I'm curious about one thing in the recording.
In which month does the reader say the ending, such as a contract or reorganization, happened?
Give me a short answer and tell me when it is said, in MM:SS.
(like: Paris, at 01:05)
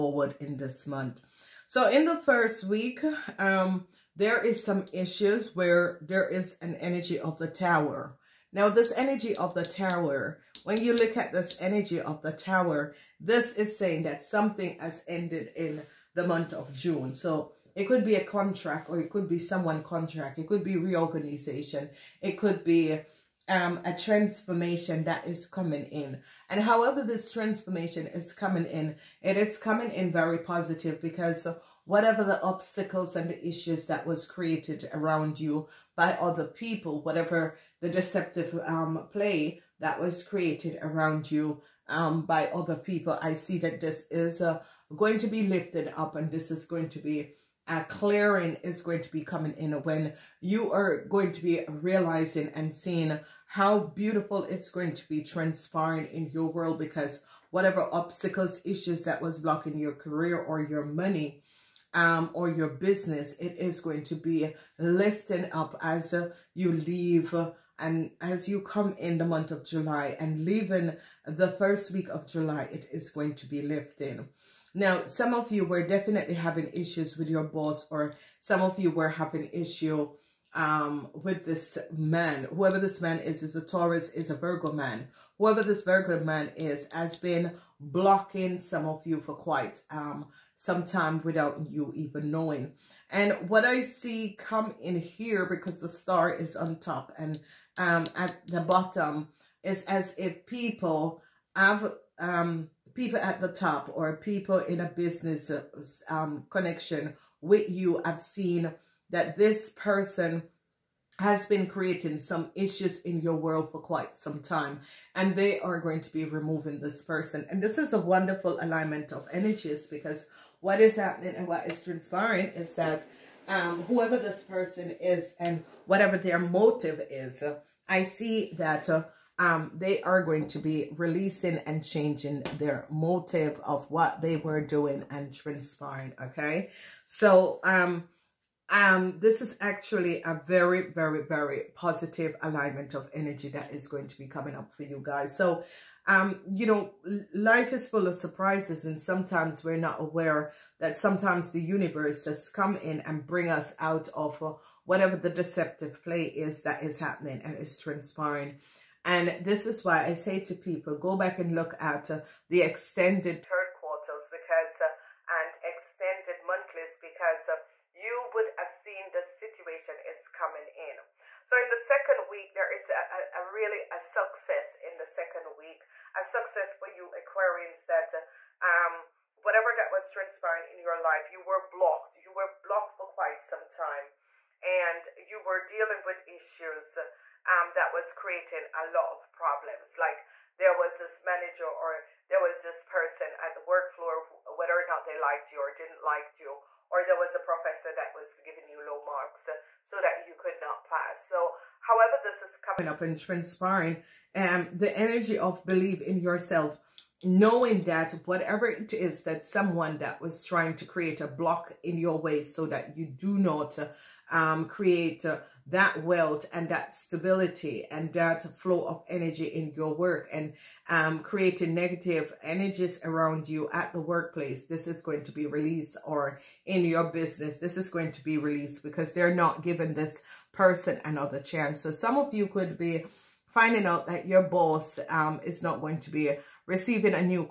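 June, at 00:16.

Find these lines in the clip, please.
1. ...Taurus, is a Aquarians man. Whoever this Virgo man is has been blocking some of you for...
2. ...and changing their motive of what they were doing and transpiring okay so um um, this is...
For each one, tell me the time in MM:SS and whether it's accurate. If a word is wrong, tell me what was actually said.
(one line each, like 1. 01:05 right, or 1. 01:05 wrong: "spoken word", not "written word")
1. 01:23 wrong: "Virgo", not "Aquarians"
2. 02:11 right.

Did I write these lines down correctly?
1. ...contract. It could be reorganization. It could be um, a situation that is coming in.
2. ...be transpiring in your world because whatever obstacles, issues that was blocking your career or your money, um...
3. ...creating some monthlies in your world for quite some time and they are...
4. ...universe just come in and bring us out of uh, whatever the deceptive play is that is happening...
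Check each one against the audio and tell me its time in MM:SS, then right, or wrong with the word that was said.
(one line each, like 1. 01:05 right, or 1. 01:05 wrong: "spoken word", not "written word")
1. 00:19 wrong: "transformation", not "situation"
2. 00:55 right
3. 01:51 wrong: "issues", not "monthlies"
4. 02:31 right.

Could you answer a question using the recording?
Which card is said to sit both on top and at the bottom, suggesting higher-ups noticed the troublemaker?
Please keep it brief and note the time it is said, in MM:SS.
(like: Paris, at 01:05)
The Star, at 01:35.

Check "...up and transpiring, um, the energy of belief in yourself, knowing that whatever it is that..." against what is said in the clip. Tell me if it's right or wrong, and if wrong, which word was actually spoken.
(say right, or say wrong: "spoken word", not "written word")
right.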